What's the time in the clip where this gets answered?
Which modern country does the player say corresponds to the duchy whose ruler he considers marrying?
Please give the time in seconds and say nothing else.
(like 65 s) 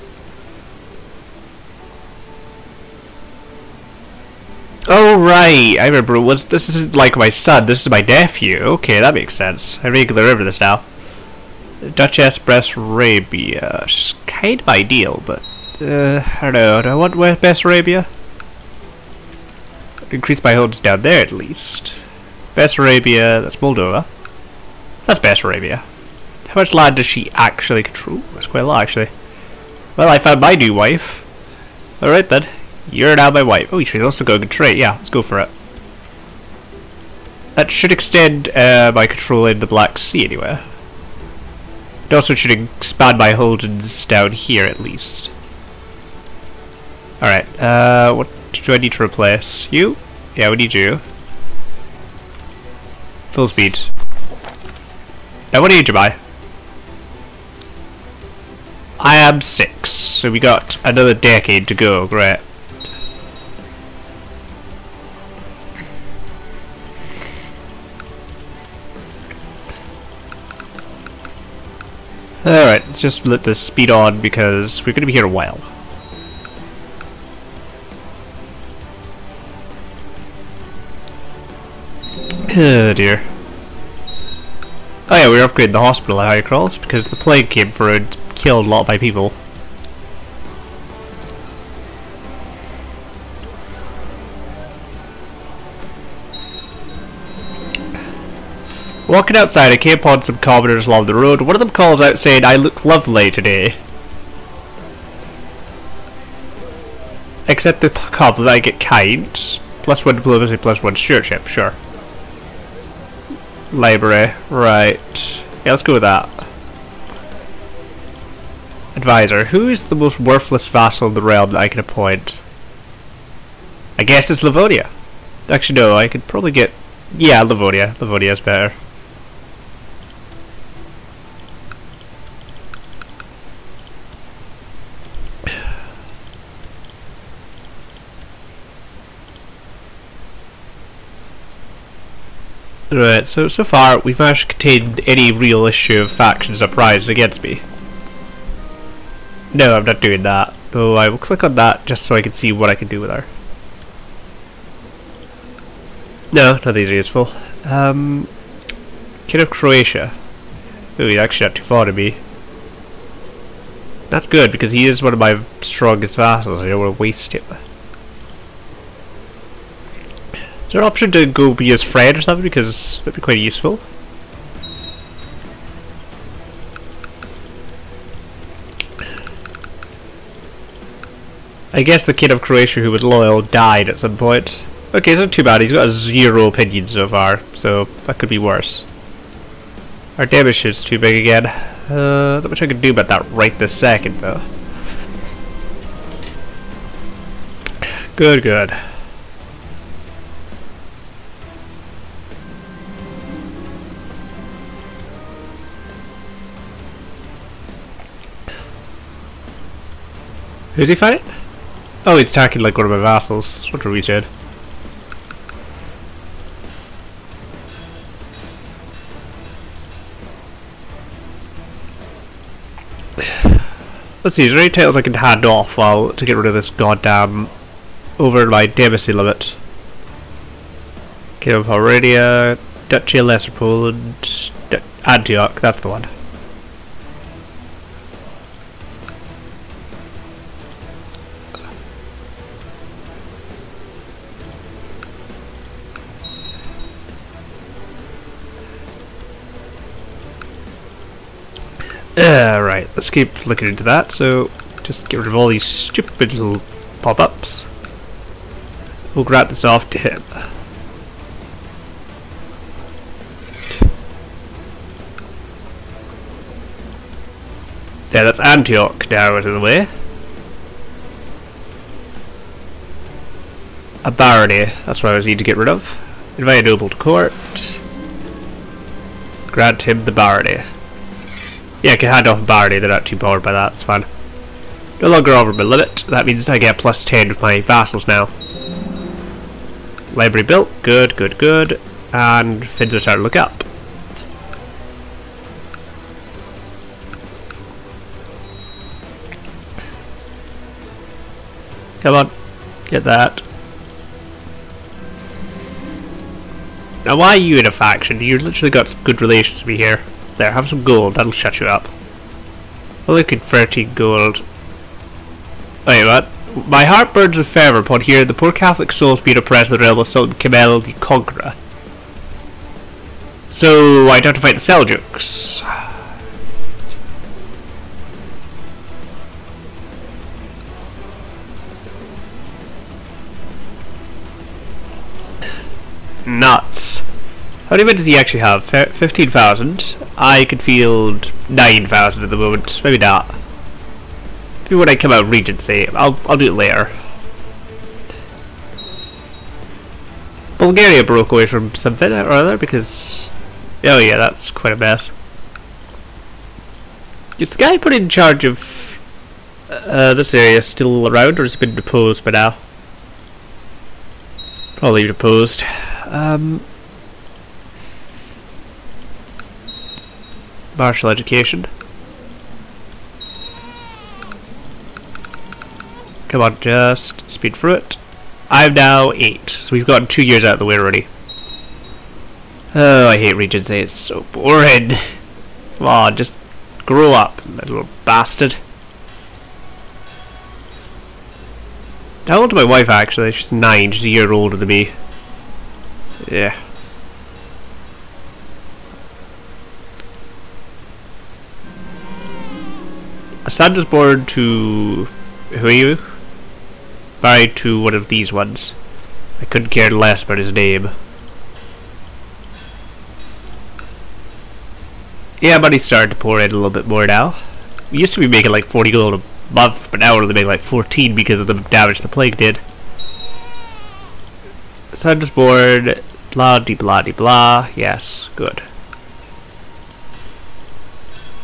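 23 s.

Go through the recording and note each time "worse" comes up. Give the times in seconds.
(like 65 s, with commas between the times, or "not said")
188 s.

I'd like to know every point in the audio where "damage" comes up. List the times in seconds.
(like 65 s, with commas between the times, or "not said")
190 s, 421 s.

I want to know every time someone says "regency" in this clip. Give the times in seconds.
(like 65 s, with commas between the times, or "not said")
345 s, 383 s.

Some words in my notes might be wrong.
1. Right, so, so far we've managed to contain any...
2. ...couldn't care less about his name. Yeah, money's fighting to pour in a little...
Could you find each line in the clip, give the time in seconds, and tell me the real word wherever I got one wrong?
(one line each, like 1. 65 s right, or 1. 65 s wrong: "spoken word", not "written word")
1. 142 s right
2. 409 s wrong: "starting", not "fighting".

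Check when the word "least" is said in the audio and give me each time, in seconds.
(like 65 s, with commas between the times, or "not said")
21 s, 44 s.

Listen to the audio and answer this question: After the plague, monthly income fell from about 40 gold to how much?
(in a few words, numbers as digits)
14.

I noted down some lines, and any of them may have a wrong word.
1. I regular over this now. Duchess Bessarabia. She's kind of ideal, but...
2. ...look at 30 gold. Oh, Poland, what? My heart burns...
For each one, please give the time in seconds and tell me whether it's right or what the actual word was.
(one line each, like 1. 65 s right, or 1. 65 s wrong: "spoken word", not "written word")
1. 9 s right
2. 313 s wrong: "Wait", not "Poland".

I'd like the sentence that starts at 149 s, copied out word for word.
No, I'm not doing that, though I will click on that just so I can see what I can do with her.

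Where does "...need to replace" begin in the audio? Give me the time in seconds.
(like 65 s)
48 s.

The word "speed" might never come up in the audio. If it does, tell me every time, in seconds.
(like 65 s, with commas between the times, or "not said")
53 s, 73 s, 377 s.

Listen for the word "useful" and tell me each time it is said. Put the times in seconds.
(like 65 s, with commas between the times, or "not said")
156 s, 173 s.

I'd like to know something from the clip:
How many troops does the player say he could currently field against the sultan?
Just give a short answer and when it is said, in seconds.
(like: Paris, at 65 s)
9,000, at 341 s.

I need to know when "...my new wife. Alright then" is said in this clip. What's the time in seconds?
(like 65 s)
30 s.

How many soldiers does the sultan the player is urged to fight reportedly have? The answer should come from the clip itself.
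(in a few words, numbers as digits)
15,000.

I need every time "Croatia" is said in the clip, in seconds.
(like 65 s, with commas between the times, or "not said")
159 s, 182 s.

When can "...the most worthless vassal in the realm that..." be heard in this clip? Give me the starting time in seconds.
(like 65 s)
119 s.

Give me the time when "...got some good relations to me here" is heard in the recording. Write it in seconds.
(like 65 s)
308 s.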